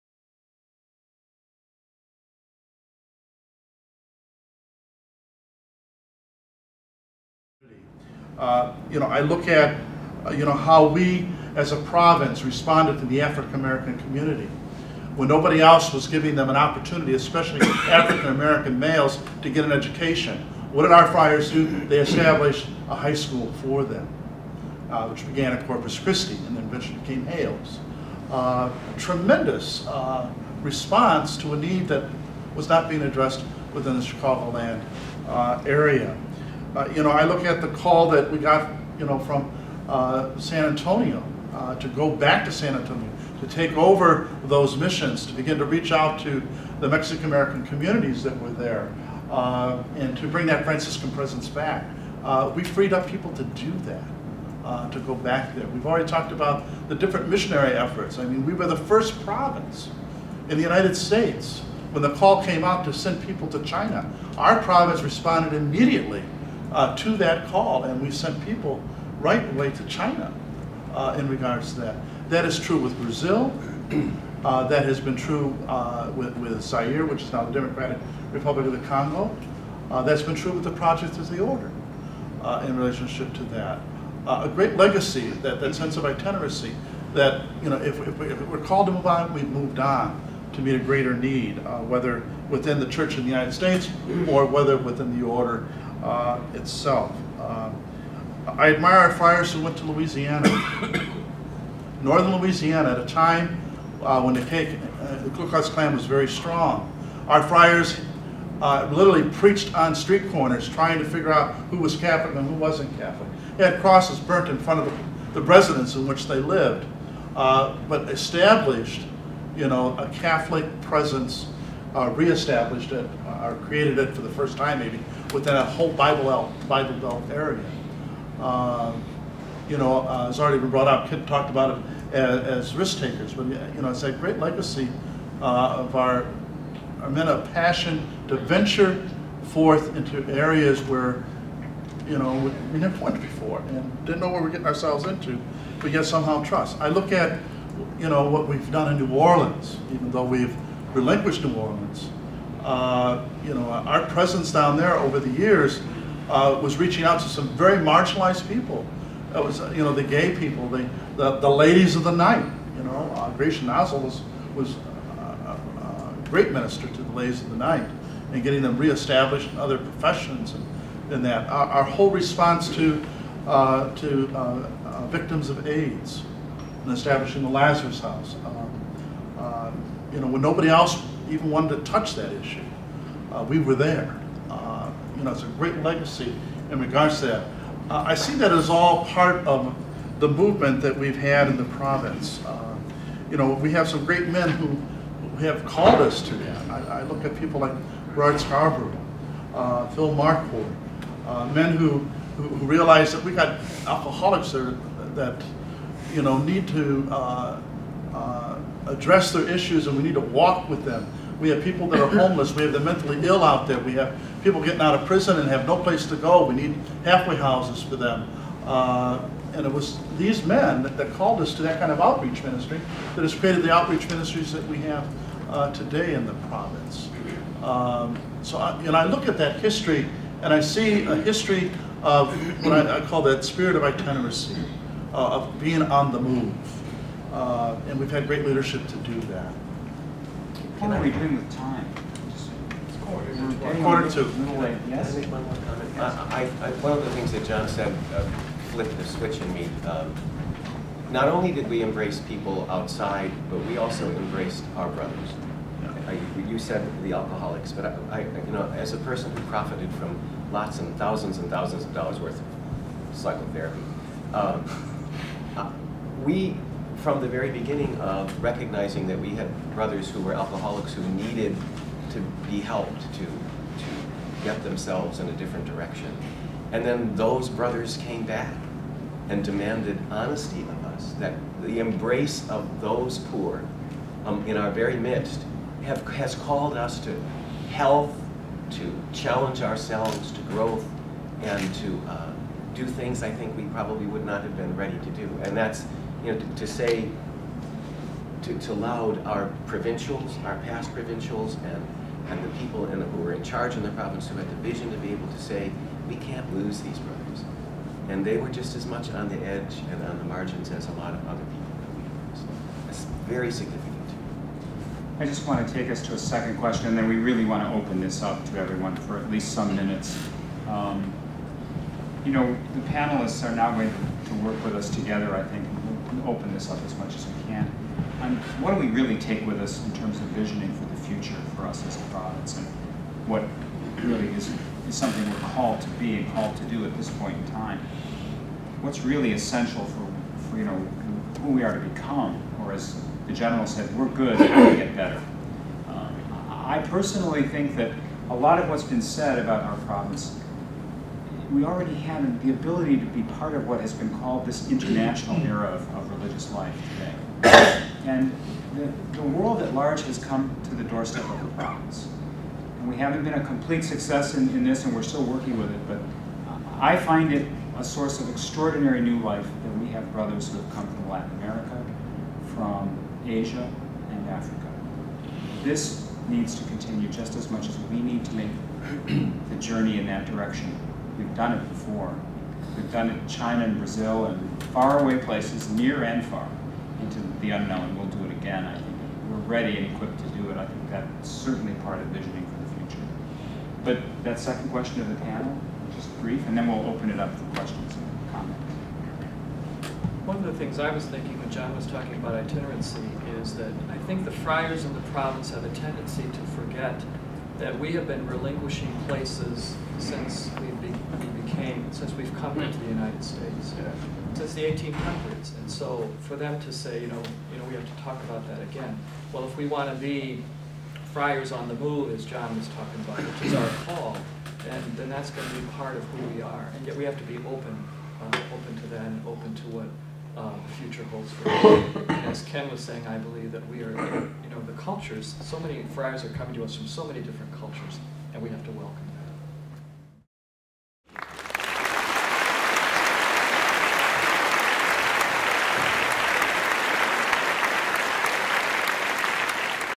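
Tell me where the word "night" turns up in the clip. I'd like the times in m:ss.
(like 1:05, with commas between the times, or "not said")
2:42, 2:47.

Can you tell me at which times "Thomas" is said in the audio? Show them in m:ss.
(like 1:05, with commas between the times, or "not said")
not said.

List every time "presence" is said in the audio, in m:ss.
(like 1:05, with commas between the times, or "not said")
0:51, 2:00, 2:34.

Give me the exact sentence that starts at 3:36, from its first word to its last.
We need halfway houses for them.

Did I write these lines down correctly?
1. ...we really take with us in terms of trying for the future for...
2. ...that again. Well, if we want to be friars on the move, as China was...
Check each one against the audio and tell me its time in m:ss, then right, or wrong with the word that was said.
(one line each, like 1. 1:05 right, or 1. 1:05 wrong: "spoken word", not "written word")
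1. 5:28 wrong: "visioning", not "trying"
2. 6:58 wrong: "John", not "China".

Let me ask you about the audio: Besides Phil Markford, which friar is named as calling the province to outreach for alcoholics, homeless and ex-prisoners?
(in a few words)
Rod Scarborough.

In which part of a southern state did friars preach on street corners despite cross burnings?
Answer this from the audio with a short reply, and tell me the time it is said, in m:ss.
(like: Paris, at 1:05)
Northern Louisiana, at 1:42.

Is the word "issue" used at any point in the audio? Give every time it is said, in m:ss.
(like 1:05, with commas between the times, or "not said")
3:02, 3:29.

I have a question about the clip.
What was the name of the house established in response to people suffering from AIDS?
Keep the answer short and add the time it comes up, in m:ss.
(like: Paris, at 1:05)
Lazarus House, at 2:57.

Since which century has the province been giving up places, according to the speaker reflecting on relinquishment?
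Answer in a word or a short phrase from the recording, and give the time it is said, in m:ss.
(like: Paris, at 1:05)
1800s, at 6:54.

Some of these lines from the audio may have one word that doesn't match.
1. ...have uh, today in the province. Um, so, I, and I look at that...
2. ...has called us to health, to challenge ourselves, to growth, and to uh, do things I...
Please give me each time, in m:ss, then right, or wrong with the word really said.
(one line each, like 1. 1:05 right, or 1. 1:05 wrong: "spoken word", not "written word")
1. 3:44 right
2. 4:46 right.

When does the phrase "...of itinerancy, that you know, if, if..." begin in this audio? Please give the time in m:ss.
1:25.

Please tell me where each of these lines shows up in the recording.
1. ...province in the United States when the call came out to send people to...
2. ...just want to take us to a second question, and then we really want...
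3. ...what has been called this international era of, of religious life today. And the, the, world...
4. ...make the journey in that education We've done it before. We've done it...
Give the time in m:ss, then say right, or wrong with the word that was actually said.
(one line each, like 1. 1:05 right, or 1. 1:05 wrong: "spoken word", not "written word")
1. 0:59 right
2. 5:15 right
3. 5:53 right
4. 6:18 wrong: "direction", not "education".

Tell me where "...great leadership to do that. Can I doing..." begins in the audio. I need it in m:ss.
3:58.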